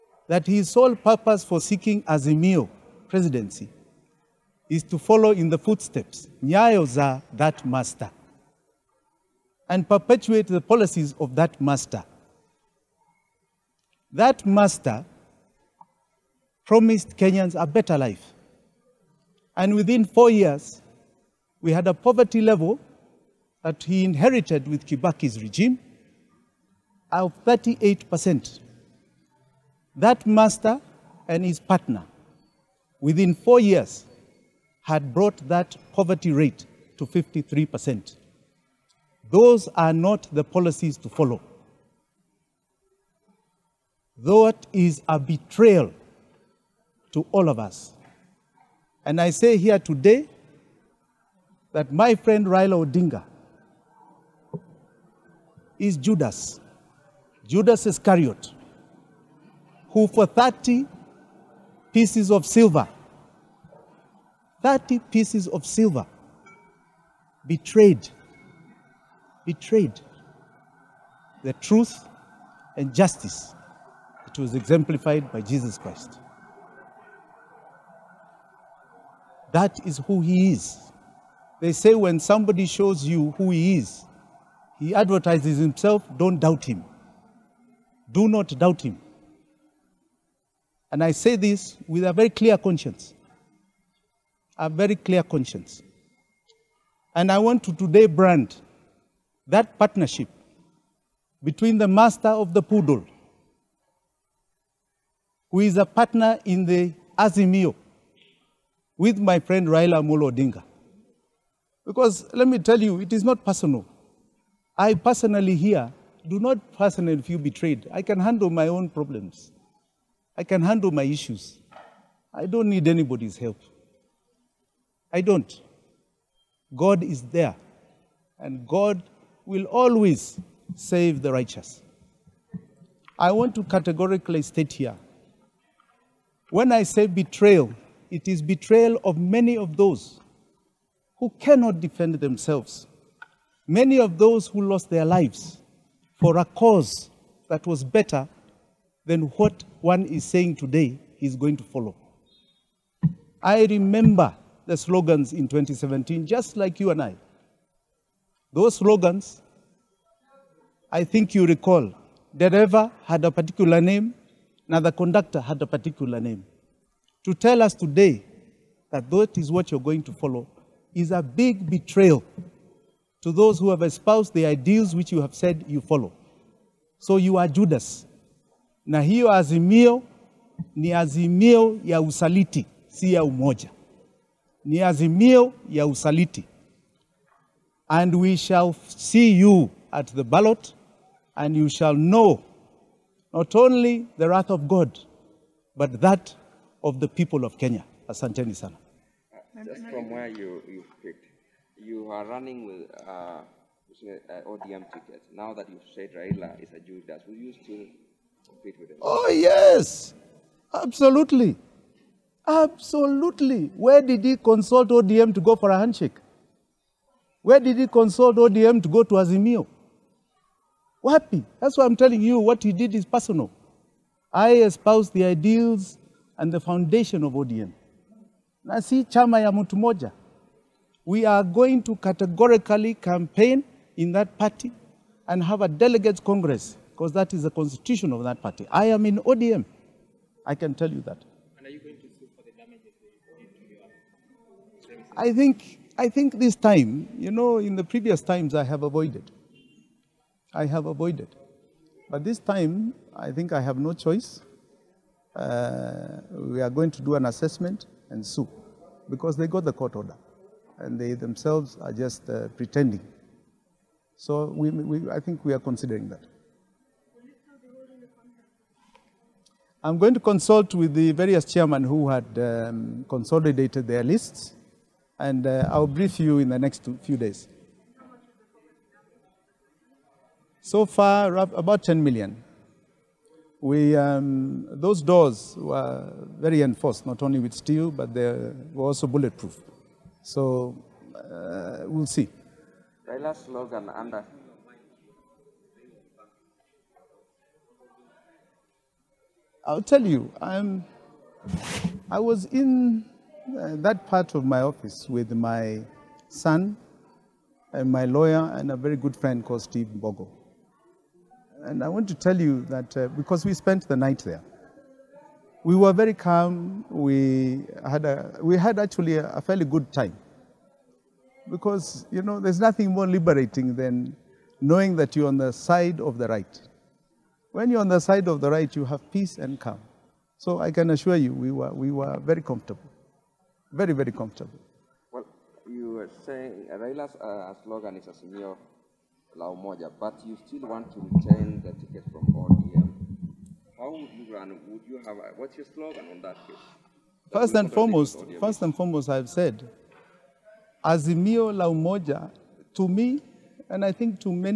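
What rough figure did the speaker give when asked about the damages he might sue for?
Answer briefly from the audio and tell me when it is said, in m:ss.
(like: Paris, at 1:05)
10 million, at 4:41.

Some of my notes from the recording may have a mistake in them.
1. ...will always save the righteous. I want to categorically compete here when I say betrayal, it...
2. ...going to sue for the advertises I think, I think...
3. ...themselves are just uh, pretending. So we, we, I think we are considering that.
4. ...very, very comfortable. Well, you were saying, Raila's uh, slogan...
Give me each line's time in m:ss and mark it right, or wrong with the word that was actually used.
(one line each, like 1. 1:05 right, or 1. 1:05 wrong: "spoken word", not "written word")
1. 2:09 wrong: "state", not "compete"
2. 4:01 wrong: "damages", not "advertises"
3. 4:21 right
4. 5:33 right.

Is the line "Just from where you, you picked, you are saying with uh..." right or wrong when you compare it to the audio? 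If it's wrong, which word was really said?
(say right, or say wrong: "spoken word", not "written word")
wrong: "running", not "saying".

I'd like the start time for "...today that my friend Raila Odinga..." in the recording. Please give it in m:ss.
0:49.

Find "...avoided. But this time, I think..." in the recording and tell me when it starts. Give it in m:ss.
4:10.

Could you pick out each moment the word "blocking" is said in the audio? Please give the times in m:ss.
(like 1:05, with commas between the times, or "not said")
not said.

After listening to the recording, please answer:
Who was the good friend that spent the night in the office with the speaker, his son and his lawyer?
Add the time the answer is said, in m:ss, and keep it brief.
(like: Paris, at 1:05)
Steve Bogo, at 5:09.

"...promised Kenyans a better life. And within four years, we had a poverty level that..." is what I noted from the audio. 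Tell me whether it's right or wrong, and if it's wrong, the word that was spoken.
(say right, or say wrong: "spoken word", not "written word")
right.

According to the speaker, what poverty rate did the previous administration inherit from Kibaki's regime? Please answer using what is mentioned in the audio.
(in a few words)
38%.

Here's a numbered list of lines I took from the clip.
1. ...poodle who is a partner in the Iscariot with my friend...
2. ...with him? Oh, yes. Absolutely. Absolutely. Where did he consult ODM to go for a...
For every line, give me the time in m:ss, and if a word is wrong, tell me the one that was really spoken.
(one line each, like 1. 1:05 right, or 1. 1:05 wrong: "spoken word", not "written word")
1. 1:42 wrong: "Azimio", not "Iscariot"
2. 3:28 right.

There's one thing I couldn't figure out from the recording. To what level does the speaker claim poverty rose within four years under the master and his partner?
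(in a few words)
53%.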